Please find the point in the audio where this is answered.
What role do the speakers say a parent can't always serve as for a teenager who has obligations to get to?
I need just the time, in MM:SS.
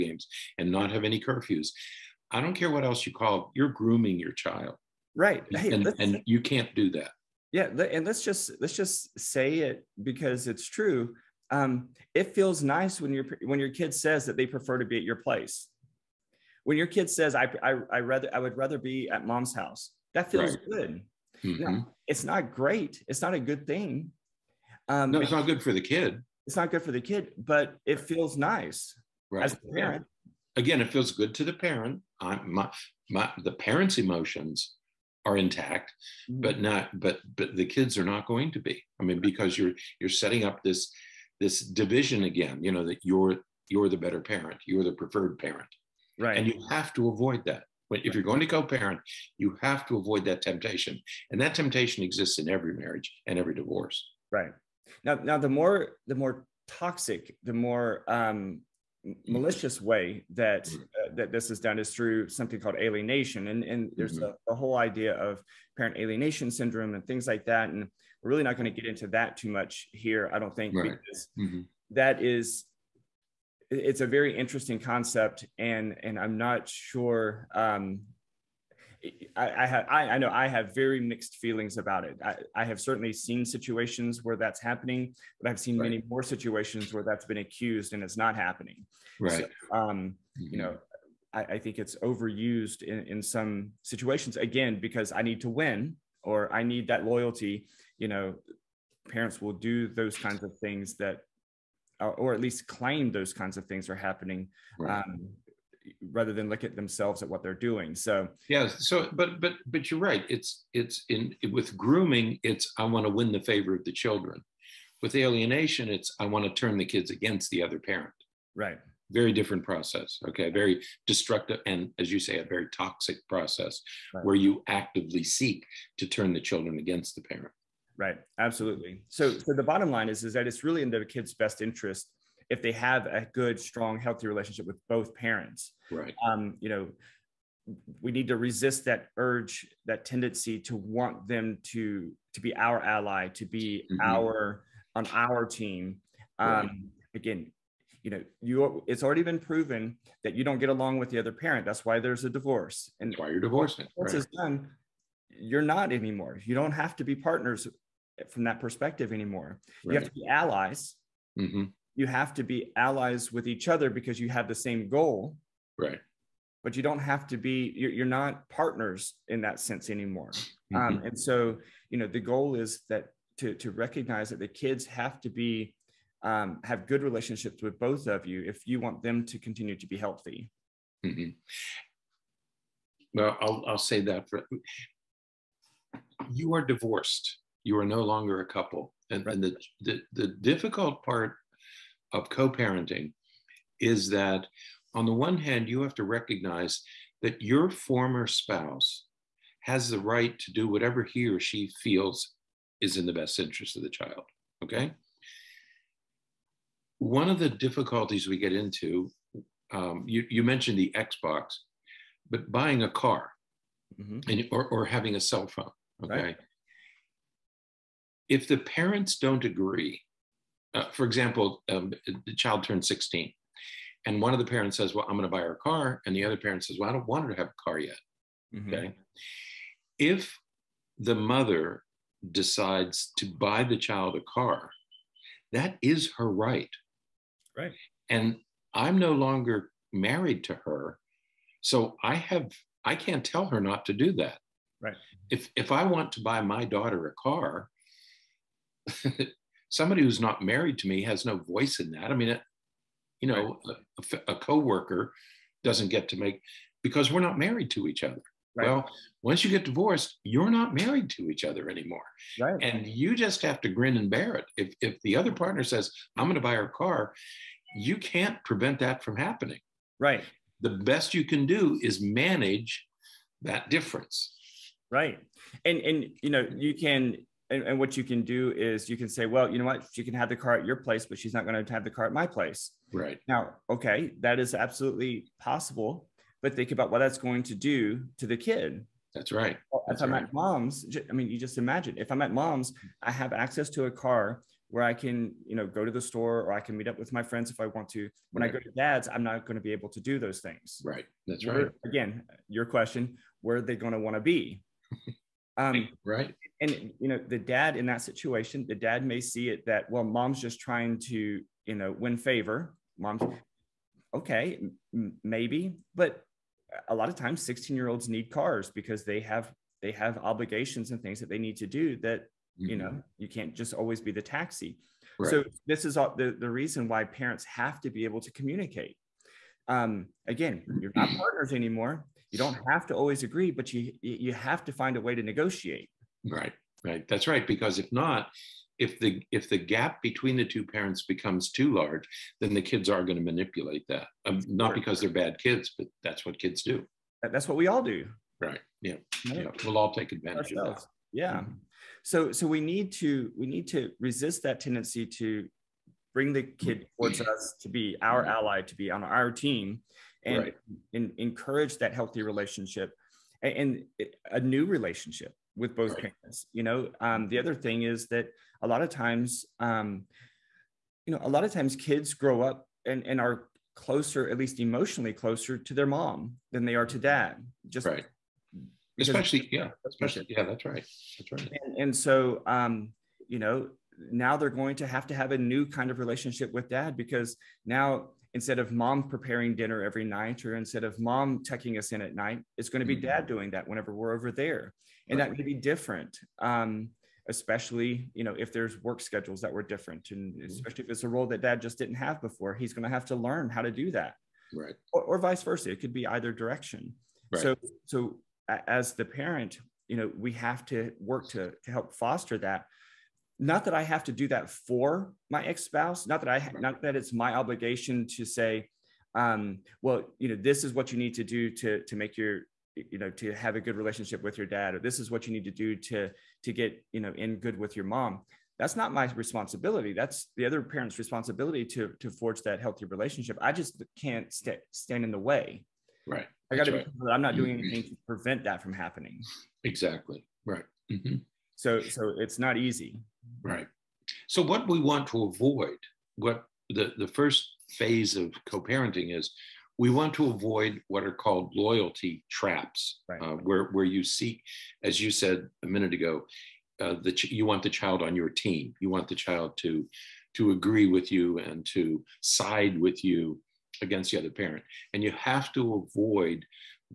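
05:24.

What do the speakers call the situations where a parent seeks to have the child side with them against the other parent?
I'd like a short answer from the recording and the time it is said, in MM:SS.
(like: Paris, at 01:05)
loyalty traps, at 07:31.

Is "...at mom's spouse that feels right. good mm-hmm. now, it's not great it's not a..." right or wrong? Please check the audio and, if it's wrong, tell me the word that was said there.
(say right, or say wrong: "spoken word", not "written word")
wrong: "house", not "spouse".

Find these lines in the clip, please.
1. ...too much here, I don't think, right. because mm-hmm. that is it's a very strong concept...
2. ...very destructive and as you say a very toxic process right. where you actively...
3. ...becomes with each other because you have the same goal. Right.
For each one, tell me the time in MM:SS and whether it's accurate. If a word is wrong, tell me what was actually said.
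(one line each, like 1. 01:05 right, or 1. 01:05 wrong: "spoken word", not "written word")
1. 01:09 wrong: "interesting", not "strong"
2. 02:00 right
3. 02:42 wrong: "allies", not "becomes".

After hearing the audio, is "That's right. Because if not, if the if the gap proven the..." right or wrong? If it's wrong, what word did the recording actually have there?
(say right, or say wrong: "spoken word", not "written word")
wrong: "between", not "proven".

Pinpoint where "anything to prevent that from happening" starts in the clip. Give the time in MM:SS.
07:17.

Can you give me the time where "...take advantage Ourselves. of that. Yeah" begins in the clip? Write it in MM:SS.
05:49.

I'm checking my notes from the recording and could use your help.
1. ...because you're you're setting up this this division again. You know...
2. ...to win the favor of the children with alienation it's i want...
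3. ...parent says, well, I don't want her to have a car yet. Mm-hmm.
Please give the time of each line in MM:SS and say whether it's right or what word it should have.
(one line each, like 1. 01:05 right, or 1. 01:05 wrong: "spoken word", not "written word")
1. 00:39 right
2. 01:53 right
3. 03:46 right.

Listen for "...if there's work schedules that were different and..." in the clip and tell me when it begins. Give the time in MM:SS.
06:38.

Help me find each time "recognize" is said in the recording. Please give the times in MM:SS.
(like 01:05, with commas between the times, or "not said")
02:53, 03:16.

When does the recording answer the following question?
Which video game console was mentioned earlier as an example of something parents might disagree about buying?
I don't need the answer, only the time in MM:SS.
03:30.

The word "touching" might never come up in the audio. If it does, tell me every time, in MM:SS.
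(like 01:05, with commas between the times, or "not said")
not said.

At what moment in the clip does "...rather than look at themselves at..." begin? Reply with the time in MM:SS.
01:46.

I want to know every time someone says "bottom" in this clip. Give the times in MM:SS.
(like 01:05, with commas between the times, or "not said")
02:09.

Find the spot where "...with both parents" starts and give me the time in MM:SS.
02:14.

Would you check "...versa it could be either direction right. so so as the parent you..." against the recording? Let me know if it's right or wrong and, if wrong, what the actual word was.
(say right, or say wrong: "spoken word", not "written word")
right.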